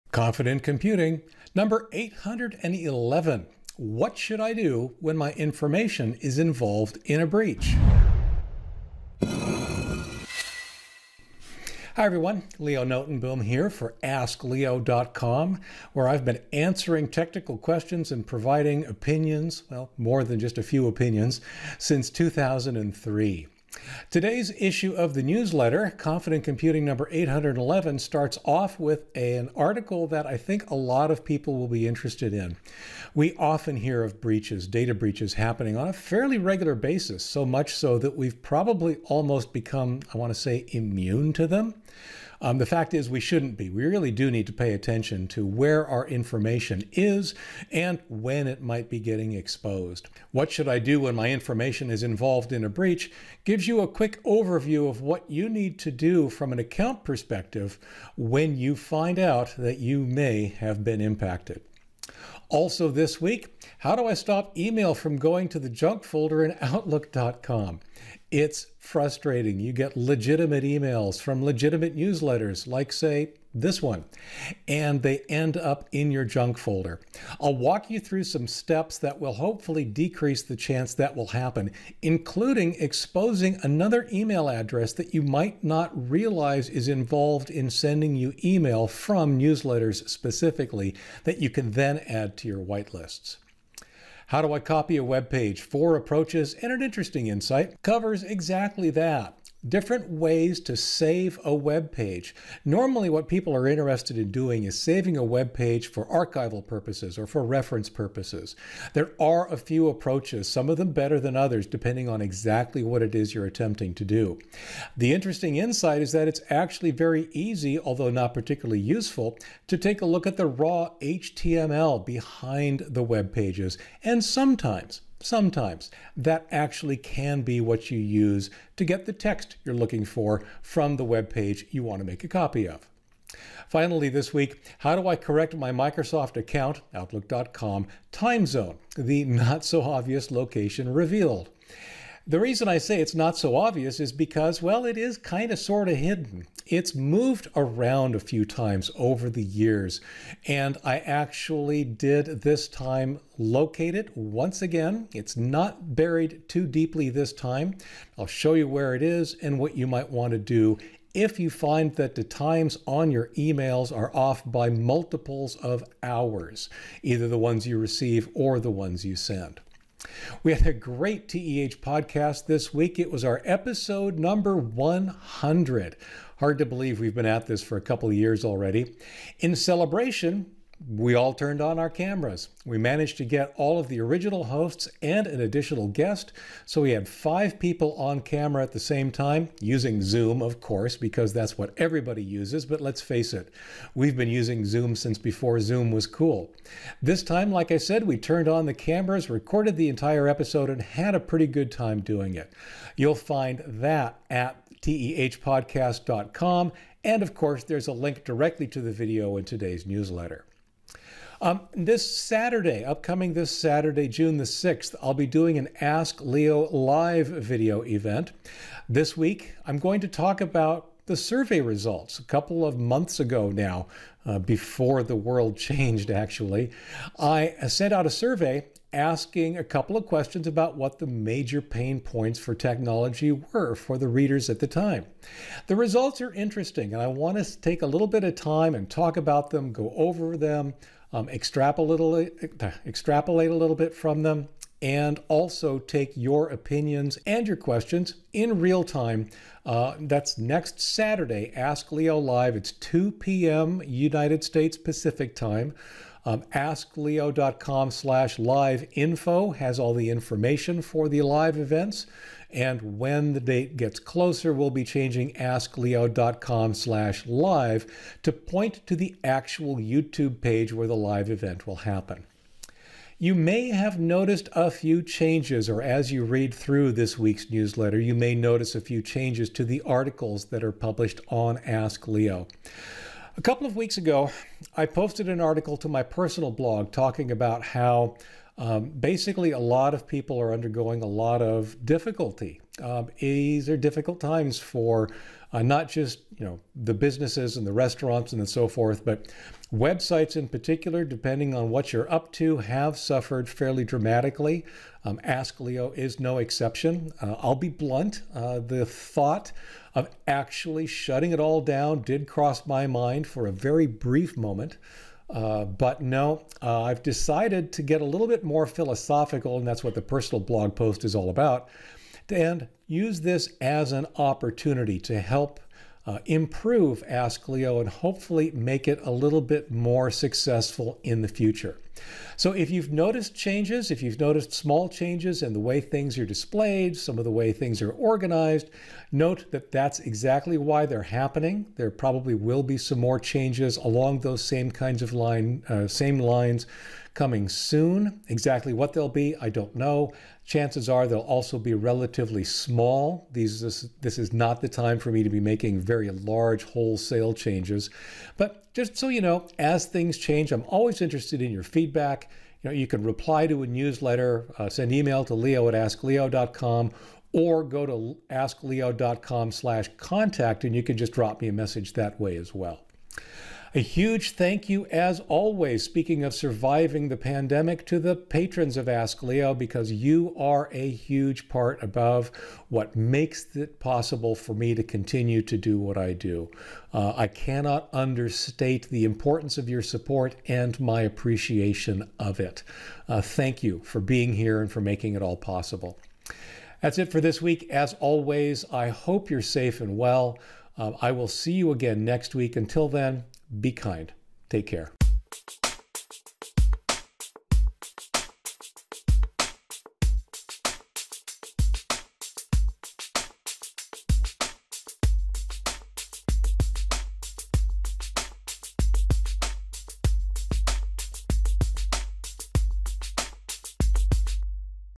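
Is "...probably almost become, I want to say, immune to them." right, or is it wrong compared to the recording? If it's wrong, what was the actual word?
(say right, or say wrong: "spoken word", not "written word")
right.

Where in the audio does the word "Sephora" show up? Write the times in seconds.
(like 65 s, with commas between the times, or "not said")
not said.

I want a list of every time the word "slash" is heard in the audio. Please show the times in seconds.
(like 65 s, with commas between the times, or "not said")
257 s, 266 s, 369 s.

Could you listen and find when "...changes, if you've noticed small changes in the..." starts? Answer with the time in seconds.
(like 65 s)
333 s.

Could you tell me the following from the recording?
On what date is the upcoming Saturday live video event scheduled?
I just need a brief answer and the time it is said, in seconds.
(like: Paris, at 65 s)
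June 6th, at 214 s.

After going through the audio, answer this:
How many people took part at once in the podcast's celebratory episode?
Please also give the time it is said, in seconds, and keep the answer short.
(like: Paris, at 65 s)
Five, at 187 s.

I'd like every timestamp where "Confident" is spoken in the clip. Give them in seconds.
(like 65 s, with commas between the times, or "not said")
0 s, 25 s.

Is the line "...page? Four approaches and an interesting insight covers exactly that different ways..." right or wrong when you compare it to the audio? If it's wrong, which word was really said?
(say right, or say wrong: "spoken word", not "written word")
right.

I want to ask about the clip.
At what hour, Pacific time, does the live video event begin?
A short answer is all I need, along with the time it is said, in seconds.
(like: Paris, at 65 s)
2 p.m., at 252 s.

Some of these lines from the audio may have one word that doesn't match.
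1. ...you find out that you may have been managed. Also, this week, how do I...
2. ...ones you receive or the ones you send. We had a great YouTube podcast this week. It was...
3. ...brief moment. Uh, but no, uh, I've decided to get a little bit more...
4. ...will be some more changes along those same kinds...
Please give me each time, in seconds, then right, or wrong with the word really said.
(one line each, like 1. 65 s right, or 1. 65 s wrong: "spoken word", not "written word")
1. 58 s wrong: "impacted", not "managed"
2. 167 s wrong: "TEH", not "YouTube"
3. 313 s right
4. 342 s right.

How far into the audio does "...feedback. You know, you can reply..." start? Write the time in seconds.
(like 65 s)
361 s.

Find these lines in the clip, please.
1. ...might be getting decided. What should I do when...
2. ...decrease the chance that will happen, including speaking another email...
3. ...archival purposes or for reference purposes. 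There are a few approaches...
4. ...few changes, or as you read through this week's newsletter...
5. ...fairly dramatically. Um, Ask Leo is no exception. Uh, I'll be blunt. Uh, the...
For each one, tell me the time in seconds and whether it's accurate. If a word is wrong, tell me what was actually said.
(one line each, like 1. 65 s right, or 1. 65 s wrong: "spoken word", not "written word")
1. 48 s wrong: "exposed", not "decided"
2. 79 s wrong: "exposing", not "speaking"
3. 106 s right
4. 274 s right
5. 303 s right.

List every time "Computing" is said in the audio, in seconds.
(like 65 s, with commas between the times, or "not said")
0 s, 26 s.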